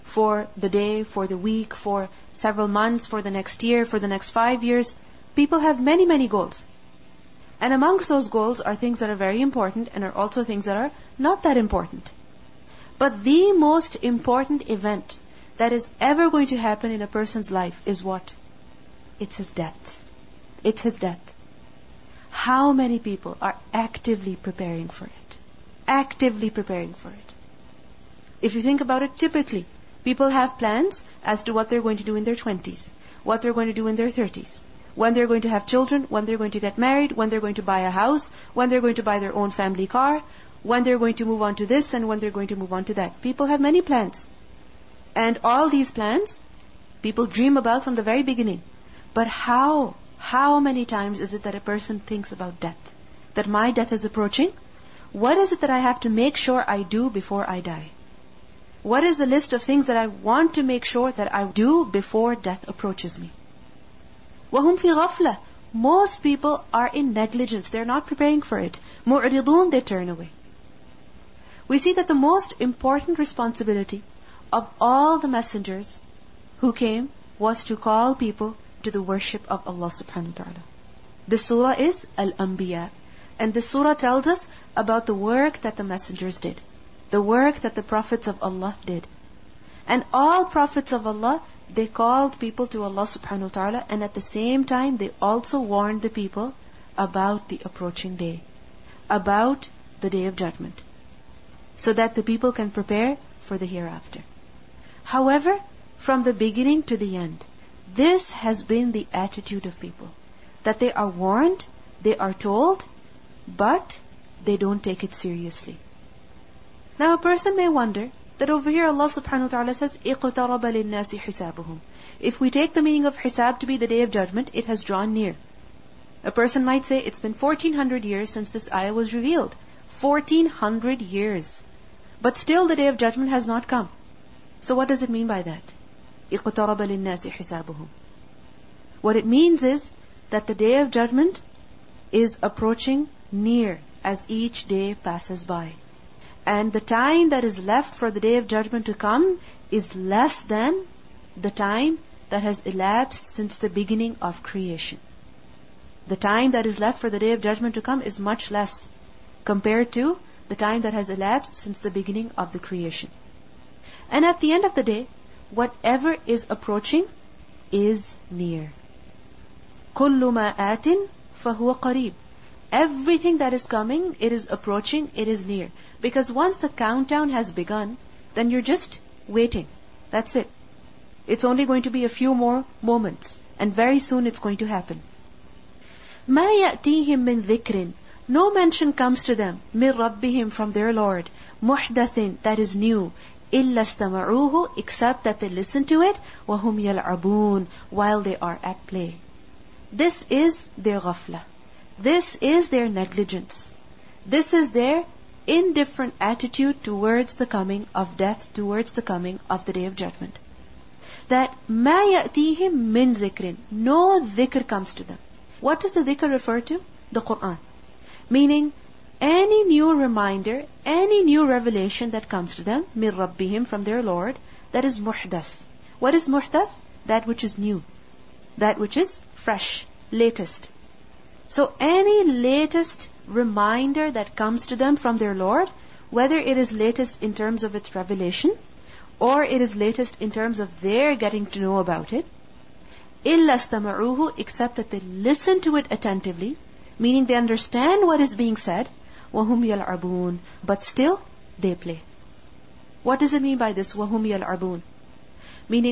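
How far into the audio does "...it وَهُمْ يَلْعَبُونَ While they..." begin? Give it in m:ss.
3:16.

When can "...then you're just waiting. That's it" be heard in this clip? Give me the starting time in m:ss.
2:58.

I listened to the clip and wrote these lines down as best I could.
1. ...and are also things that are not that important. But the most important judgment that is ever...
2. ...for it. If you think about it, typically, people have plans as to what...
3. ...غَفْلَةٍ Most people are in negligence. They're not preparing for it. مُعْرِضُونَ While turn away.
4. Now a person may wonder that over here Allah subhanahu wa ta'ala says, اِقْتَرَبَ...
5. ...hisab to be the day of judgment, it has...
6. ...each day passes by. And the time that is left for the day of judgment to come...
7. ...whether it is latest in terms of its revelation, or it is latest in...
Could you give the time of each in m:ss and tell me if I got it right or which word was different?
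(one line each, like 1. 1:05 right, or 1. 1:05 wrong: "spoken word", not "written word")
1. 0:09 wrong: "event", not "judgment"
2. 0:26 right
3. 1:04 wrong: "They", not "While"
4. 1:56 right
5. 2:03 right
6. 2:24 right
7. 3:56 right.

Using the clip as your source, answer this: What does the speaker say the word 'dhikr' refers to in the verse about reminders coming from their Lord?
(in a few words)
The Qur'an.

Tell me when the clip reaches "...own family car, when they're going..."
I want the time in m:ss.
0:39.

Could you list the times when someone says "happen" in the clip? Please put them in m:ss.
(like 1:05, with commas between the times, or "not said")
0:16, 3:04.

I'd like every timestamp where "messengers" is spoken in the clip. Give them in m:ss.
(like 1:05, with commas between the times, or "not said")
1:15, 1:25.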